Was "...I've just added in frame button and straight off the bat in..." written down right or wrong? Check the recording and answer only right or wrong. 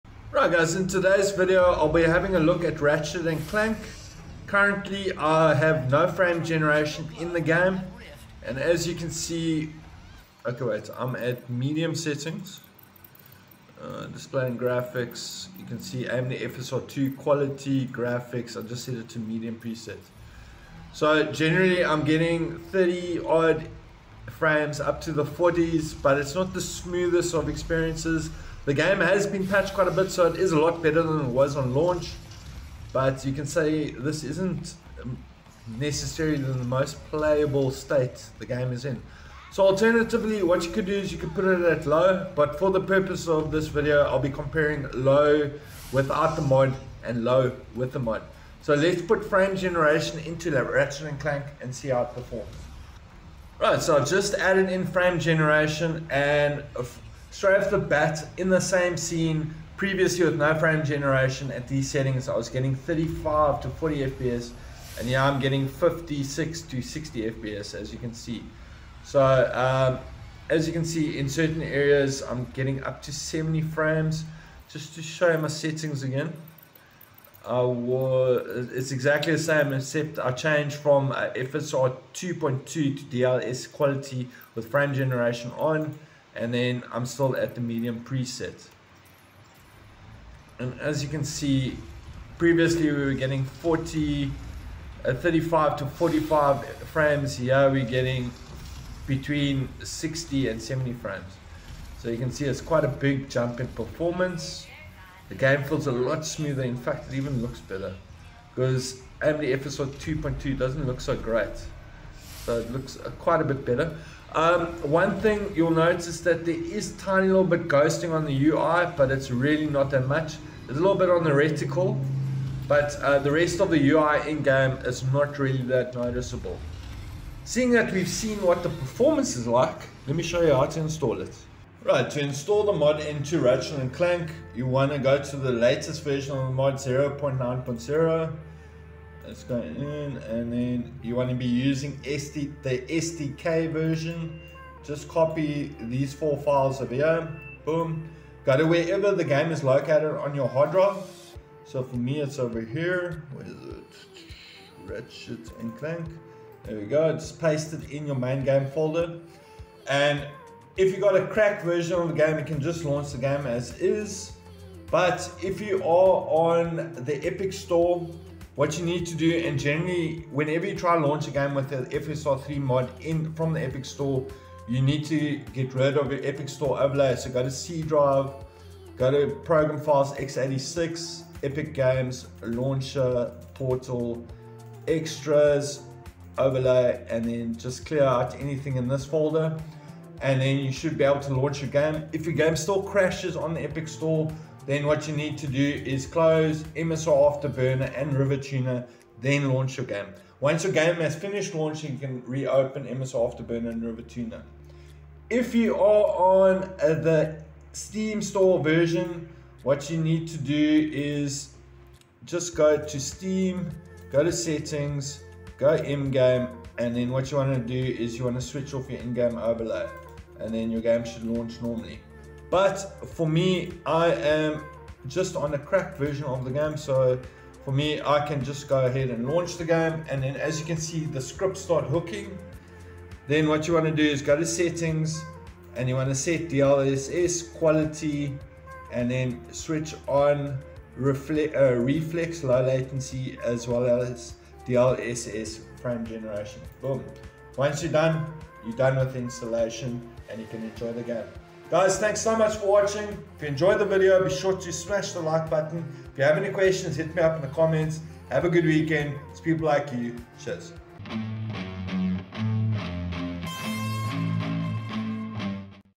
wrong.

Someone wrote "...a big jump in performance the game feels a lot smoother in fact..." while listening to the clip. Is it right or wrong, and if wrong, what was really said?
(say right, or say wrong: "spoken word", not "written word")
right.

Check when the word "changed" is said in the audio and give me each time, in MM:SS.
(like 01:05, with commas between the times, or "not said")
01:20.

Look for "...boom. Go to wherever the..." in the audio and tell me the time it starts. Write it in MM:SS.
02:27.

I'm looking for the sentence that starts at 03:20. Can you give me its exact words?
Once your game has finished launching, you can reopen MSI Afterburner and RivaTuner.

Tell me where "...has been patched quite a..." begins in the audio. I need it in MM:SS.
00:28.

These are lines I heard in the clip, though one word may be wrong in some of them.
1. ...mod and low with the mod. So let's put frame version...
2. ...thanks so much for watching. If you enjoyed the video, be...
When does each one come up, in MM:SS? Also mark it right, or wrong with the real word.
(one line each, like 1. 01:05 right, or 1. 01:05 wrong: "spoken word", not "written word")
1. 00:46 wrong: "generation", not "version"
2. 04:11 right.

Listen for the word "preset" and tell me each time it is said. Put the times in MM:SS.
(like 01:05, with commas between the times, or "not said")
00:19, 01:28.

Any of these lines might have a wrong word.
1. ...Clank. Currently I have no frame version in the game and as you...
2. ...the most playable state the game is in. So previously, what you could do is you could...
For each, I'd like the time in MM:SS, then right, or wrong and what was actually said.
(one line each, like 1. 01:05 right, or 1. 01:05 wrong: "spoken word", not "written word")
1. 00:03 wrong: "generation", not "version"
2. 00:36 wrong: "alternatively", not "previously".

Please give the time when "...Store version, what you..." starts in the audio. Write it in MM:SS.
03:28.